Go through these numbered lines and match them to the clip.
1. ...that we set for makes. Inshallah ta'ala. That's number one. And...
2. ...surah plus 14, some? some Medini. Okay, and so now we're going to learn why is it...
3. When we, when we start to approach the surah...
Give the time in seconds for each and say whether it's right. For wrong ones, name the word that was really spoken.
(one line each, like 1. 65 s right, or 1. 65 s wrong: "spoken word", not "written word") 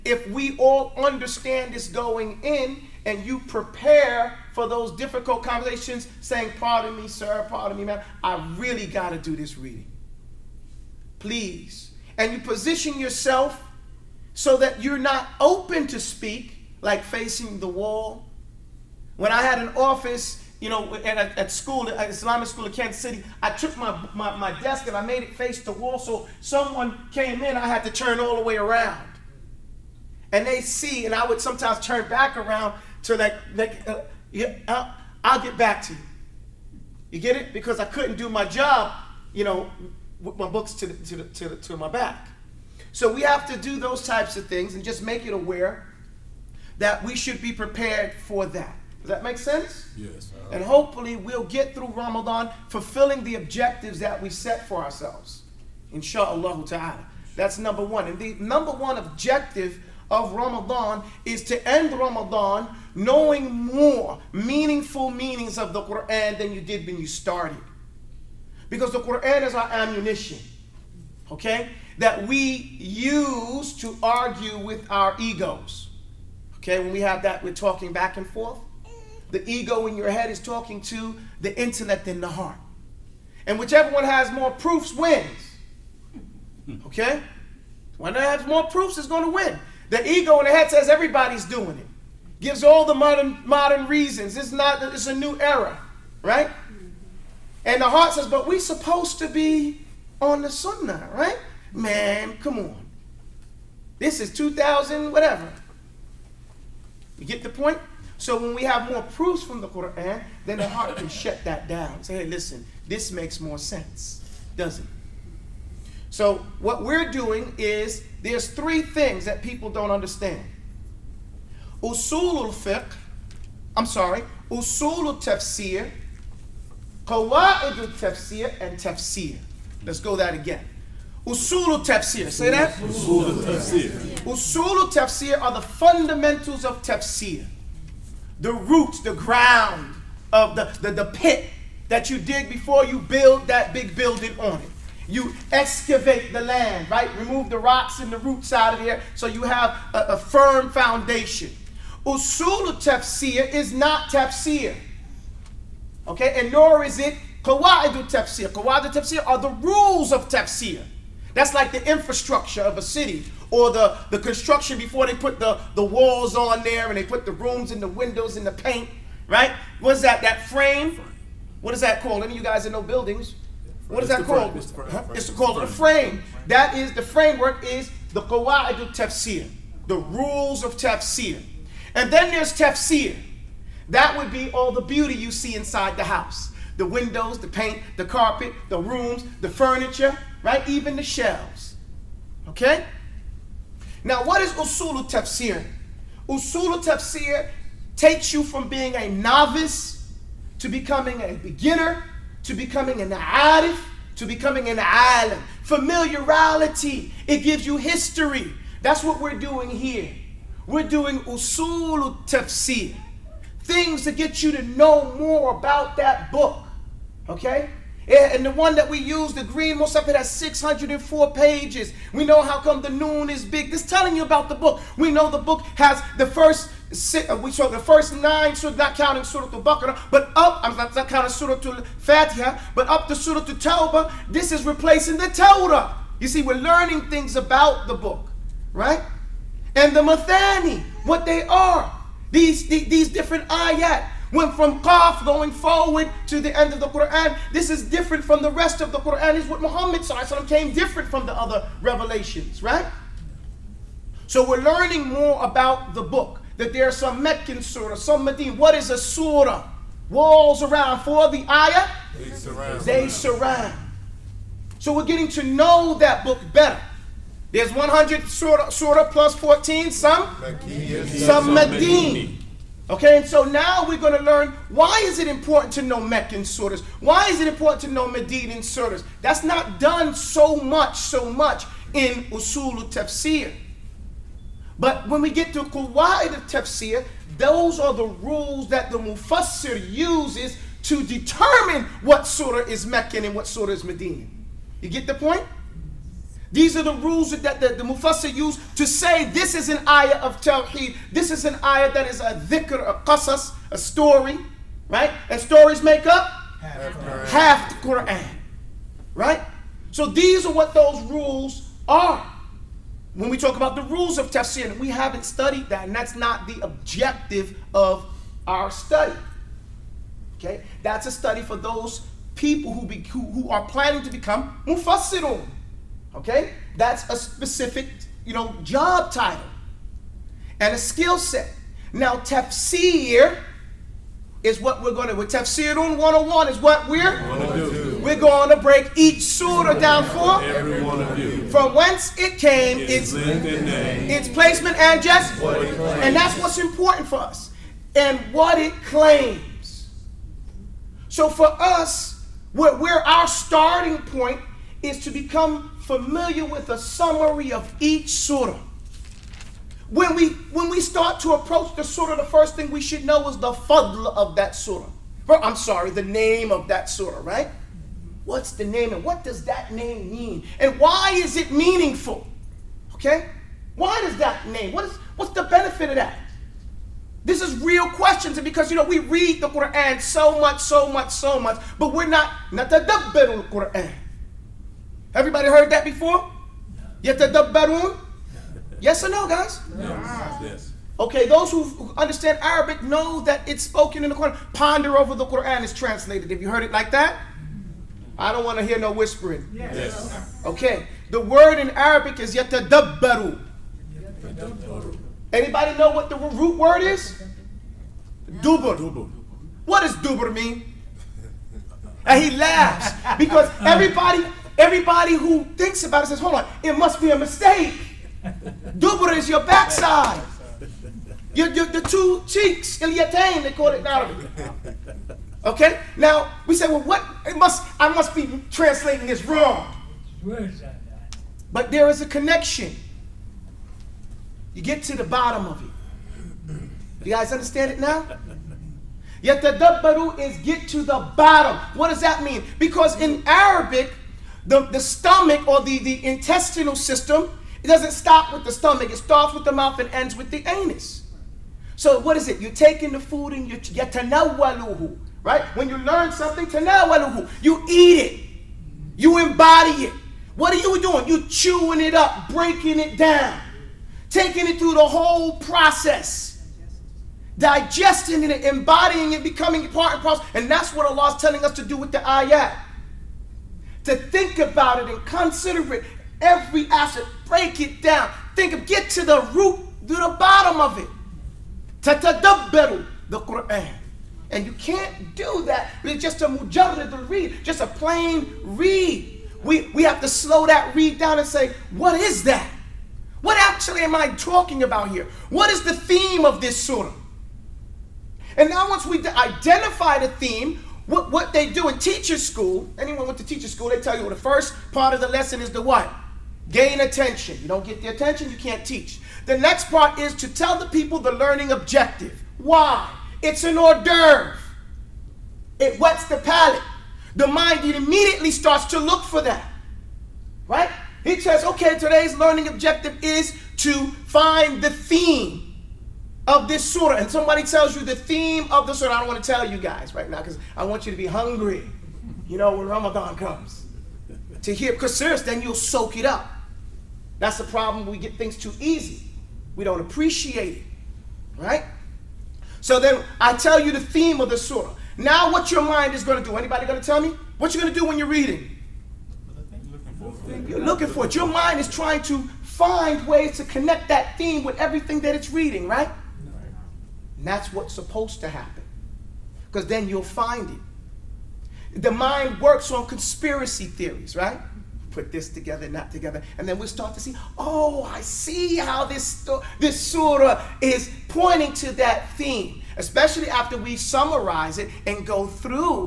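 1. 53 s wrong: "ourselves", not "makes"
2. 268 s right
3. 359 s right.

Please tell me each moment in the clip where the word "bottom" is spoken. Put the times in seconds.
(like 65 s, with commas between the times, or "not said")
435 s, 441 s, 480 s.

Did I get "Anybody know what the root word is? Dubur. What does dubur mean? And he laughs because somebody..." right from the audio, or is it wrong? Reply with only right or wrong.
wrong.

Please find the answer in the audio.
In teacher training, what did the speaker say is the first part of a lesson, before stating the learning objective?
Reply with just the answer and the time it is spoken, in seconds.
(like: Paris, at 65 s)
Gain attention, at 506 s.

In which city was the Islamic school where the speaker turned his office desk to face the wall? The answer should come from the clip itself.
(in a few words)
Kansas City.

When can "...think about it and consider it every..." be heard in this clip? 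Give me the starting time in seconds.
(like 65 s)
473 s.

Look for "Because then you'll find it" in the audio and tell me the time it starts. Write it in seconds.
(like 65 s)
559 s.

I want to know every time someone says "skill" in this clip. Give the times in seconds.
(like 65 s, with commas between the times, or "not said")
330 s.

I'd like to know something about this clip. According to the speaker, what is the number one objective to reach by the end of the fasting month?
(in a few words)
Knowing more meaningful meanings of the Quran.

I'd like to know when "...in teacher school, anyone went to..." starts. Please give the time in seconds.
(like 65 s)
501 s.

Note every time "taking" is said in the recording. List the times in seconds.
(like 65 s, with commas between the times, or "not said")
452 s, 464 s.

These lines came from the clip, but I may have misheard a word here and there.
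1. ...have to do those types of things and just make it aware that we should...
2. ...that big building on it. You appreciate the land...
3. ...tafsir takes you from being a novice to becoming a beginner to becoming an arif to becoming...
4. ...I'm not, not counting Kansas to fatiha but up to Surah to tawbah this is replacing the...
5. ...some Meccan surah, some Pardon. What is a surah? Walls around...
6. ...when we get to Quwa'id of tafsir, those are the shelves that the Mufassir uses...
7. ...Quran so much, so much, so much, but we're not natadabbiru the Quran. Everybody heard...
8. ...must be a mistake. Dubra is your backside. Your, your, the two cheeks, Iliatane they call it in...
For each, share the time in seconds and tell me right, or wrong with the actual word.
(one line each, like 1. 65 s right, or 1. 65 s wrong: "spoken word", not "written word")
1. 43 s right
2. 143 s wrong: "excavate", not "appreciate"
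3. 196 s right
4. 230 s wrong: "Surah", not "Kansas"
5. 256 s wrong: "Medina", not "Pardon"
6. 285 s wrong: "rules", not "shelves"
7. 379 s right
8. 416 s right.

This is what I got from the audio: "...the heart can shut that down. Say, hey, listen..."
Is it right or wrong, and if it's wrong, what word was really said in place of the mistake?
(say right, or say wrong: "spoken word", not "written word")
right.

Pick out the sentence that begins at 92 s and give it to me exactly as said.
Gives all the modern modern reasons.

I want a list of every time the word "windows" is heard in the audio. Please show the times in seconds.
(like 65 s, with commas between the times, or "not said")
167 s, 186 s.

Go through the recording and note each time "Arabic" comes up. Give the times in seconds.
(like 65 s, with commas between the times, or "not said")
392 s, 401 s, 423 s, 443 s.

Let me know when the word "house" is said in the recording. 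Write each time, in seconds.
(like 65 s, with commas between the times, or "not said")
186 s.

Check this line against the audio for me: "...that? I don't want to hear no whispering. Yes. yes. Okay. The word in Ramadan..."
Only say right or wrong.
wrong.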